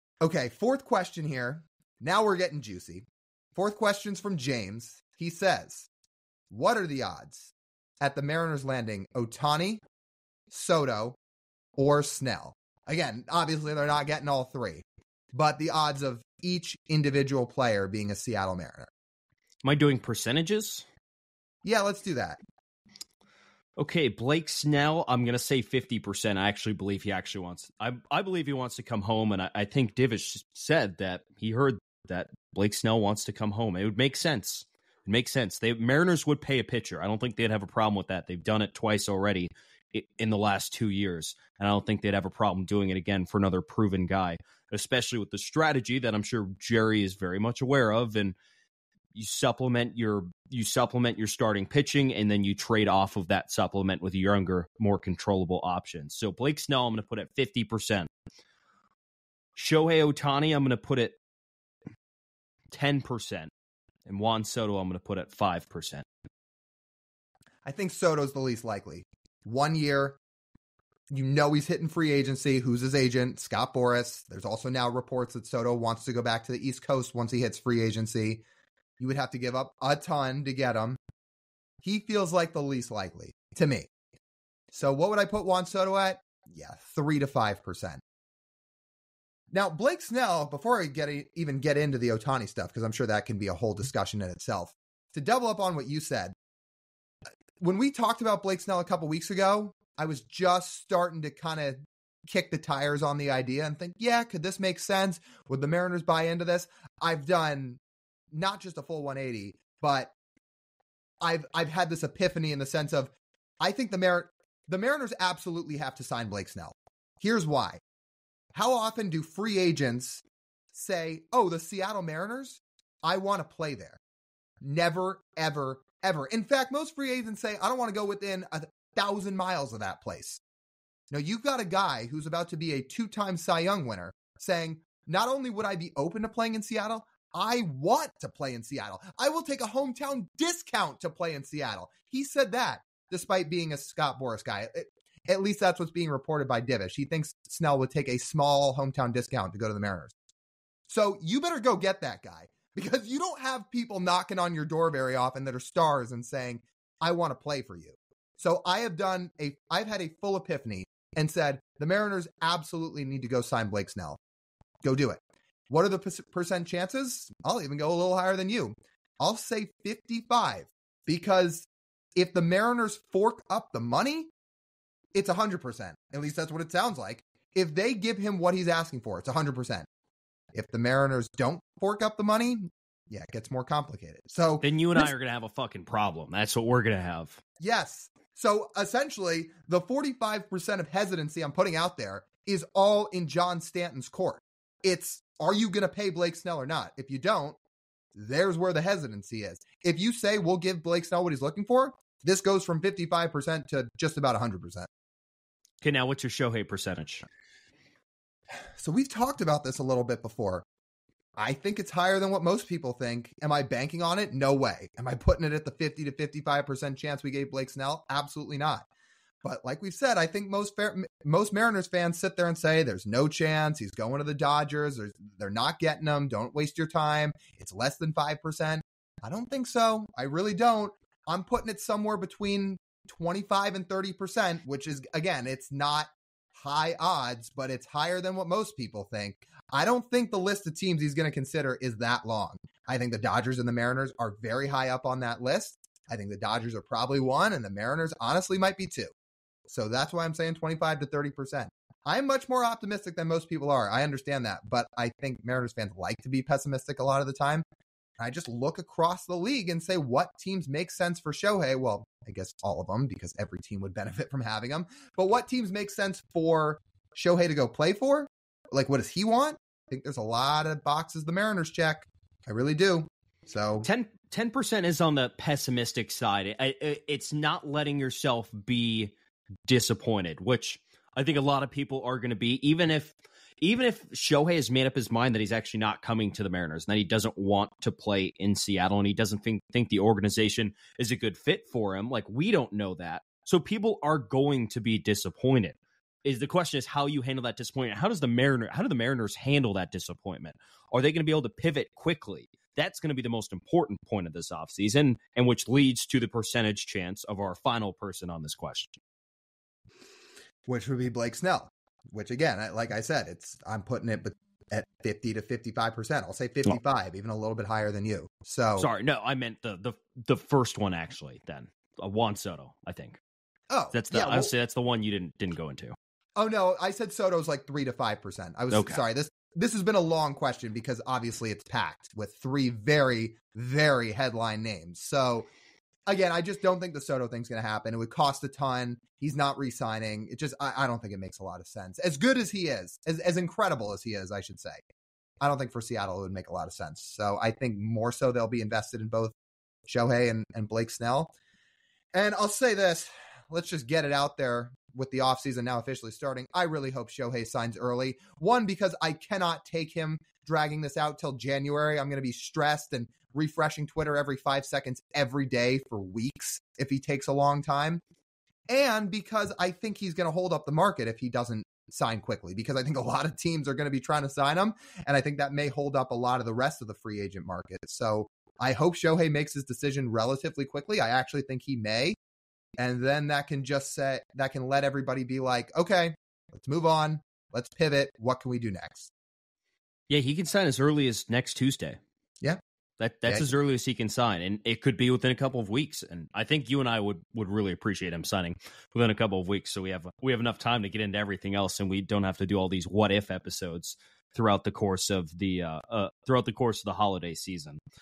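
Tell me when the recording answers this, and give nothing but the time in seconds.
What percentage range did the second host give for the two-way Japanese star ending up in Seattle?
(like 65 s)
233 s.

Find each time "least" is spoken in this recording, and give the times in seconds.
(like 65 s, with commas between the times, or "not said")
68 s, 82 s, 145 s, 176 s.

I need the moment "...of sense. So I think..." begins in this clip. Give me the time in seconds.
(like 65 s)
346 s.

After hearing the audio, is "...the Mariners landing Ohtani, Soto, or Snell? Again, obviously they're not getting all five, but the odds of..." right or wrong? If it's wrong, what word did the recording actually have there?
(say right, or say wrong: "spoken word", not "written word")
wrong: "three", not "five".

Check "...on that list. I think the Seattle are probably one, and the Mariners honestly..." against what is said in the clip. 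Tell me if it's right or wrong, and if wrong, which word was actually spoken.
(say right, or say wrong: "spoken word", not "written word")
wrong: "Dodgers", not "Seattle".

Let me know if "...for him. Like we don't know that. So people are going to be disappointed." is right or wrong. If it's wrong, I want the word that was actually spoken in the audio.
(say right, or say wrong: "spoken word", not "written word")
right.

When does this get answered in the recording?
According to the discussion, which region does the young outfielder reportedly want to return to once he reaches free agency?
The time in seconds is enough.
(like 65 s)
76 s.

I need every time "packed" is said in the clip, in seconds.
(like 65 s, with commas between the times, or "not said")
331 s.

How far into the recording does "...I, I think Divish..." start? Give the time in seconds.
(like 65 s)
29 s.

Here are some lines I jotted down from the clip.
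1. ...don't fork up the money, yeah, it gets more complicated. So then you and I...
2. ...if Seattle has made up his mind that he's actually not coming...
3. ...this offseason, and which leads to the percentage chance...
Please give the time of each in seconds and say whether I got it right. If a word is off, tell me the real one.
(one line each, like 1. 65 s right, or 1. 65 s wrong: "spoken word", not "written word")
1. 181 s right
2. 283 s wrong: "Shohei", not "Seattle"
3. 304 s right.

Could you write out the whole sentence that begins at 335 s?
So again, I just don't think the Soto thing's going to happen.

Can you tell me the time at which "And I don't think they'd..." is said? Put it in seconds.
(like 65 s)
41 s.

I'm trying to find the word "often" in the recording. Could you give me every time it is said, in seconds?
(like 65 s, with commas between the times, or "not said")
118 s, 155 s.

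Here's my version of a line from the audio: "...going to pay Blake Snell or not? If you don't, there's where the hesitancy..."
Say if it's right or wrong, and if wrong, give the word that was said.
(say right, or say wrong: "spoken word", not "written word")
right.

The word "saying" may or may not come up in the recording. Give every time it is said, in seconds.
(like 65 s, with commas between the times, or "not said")
134 s, 156 s, 250 s.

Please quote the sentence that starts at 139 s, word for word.
I will take a hometown discount to play in Seattle.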